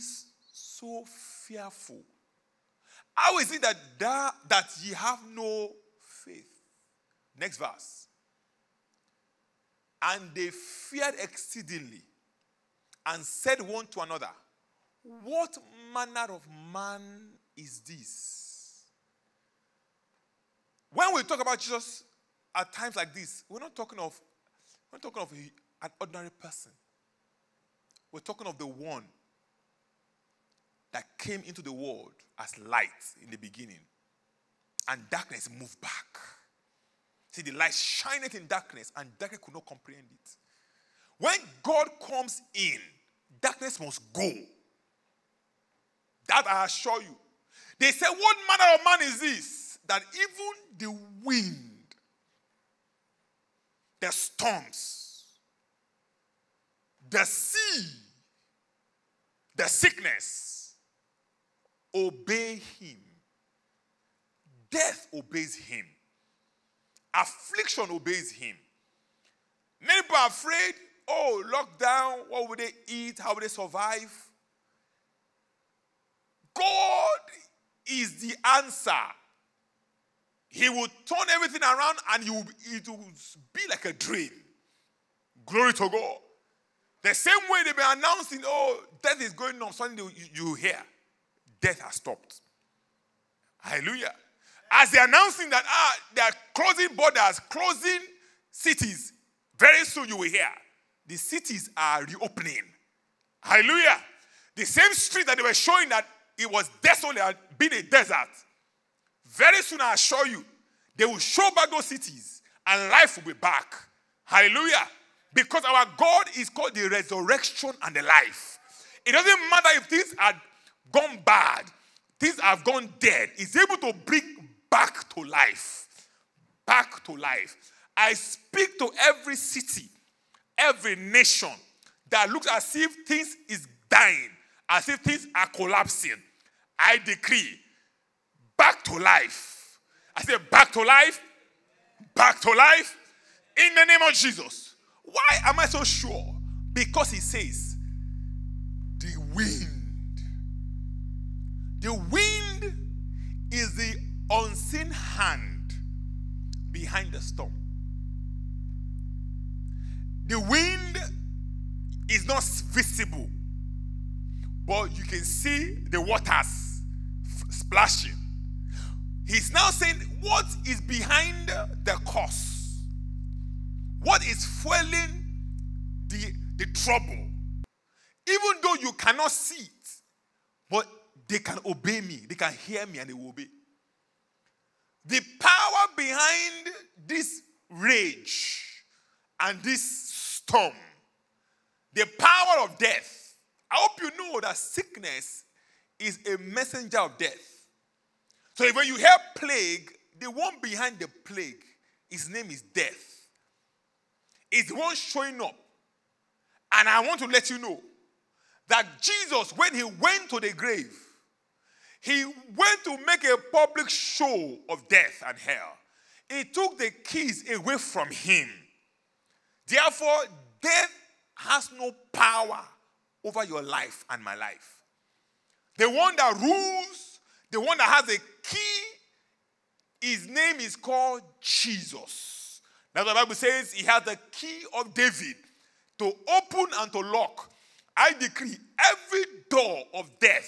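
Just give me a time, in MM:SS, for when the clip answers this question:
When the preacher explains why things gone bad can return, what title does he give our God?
01:56.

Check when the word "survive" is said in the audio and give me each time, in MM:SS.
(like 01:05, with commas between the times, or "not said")
01:13.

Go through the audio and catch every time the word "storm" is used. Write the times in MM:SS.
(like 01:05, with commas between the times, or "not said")
00:54, 02:37, 03:09.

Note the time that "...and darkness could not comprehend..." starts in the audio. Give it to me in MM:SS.
00:38.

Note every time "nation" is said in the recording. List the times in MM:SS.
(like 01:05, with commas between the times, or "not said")
02:10.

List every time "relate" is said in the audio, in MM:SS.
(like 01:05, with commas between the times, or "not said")
not said.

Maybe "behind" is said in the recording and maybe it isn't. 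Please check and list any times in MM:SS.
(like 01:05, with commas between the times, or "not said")
02:36, 02:50, 03:05, 03:20.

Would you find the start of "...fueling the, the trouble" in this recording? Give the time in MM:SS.
02:54.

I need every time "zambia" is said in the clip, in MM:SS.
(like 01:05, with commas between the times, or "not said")
not said.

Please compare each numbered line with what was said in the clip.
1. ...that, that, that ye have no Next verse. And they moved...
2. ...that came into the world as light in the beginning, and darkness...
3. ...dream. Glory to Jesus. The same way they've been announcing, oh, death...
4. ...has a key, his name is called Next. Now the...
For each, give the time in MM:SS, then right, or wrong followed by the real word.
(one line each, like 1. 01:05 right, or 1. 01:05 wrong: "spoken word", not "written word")
1. 00:03 wrong: "feared", not "moved"
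2. 00:30 right
3. 01:23 wrong: "God", not "Jesus"
4. 03:47 wrong: "Jesus", not "Next".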